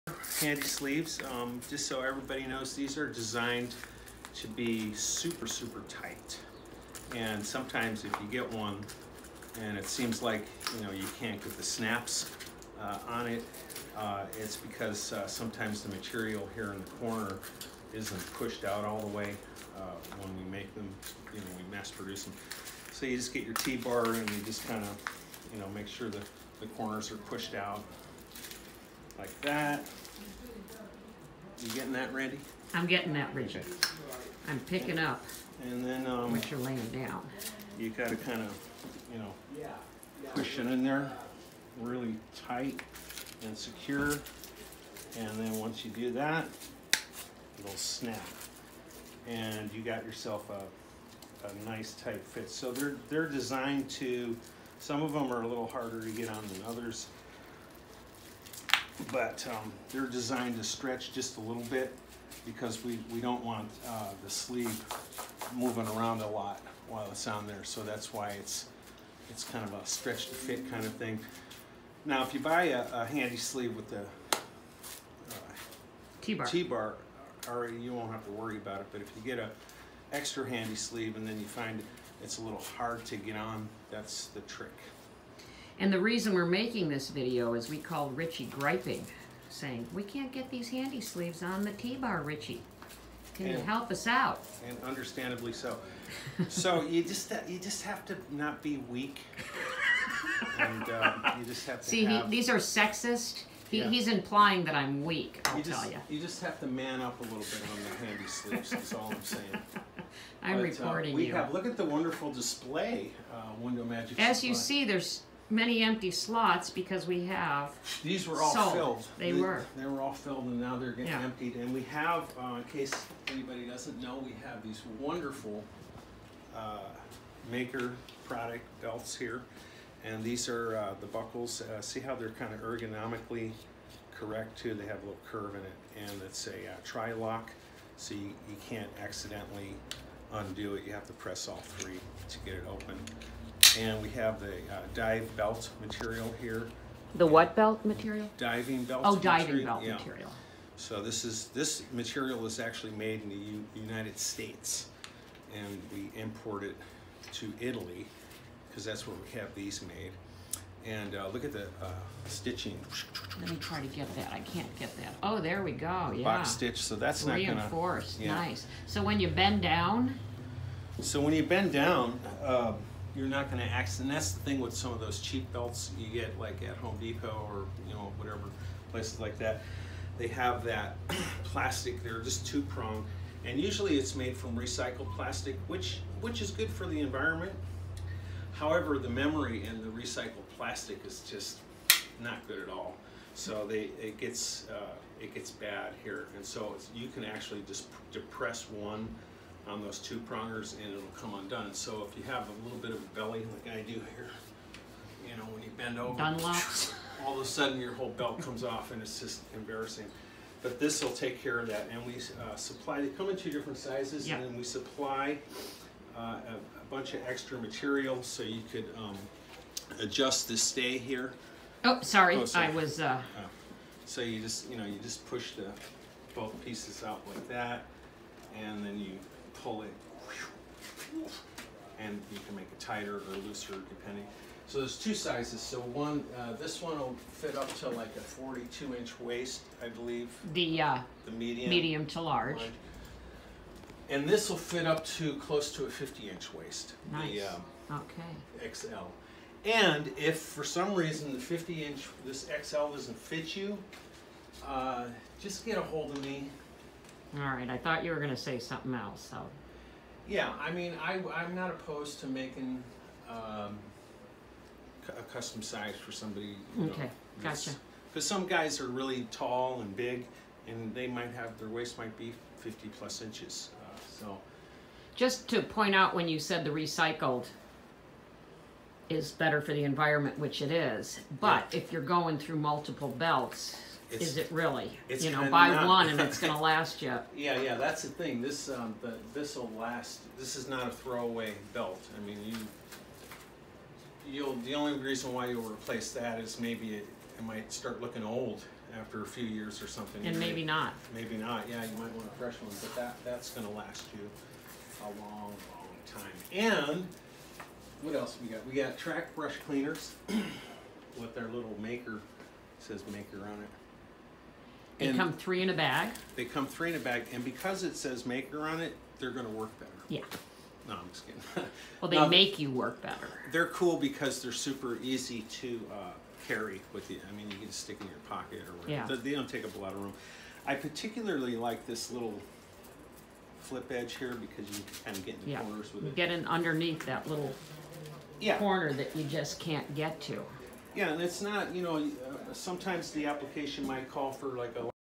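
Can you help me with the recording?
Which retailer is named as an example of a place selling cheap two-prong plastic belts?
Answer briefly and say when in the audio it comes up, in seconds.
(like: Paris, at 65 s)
Home Depot, at 176 s.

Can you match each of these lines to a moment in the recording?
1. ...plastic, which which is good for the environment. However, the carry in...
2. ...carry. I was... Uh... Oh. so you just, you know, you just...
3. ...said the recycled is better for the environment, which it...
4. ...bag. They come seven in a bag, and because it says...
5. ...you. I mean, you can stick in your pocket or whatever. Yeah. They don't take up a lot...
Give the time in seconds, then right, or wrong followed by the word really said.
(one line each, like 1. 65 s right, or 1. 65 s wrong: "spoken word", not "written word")
1. 185 s wrong: "memory", not "carry"
2. 222 s wrong: "sorry", not "carry"
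3. 276 s right
4. 315 s wrong: "three", not "seven"
5. 327 s right.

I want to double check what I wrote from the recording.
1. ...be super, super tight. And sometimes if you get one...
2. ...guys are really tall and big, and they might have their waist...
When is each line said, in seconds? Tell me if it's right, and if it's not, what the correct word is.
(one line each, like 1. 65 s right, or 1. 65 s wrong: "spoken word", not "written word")
1. 4 s right
2. 268 s right.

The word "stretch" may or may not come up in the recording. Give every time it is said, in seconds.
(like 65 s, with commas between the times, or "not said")
60 s, 69 s.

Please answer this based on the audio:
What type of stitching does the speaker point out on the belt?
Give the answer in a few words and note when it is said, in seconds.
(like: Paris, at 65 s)
Box stitch, at 166 s.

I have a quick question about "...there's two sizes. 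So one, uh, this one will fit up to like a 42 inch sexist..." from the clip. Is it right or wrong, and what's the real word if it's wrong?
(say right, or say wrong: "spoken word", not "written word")
wrong: "waist", not "sexist".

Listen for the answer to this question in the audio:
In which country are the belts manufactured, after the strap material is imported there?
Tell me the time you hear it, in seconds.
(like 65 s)
157 s.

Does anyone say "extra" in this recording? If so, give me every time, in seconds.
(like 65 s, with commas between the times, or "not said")
80 s, 217 s.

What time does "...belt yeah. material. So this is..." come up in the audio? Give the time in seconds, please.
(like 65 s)
149 s.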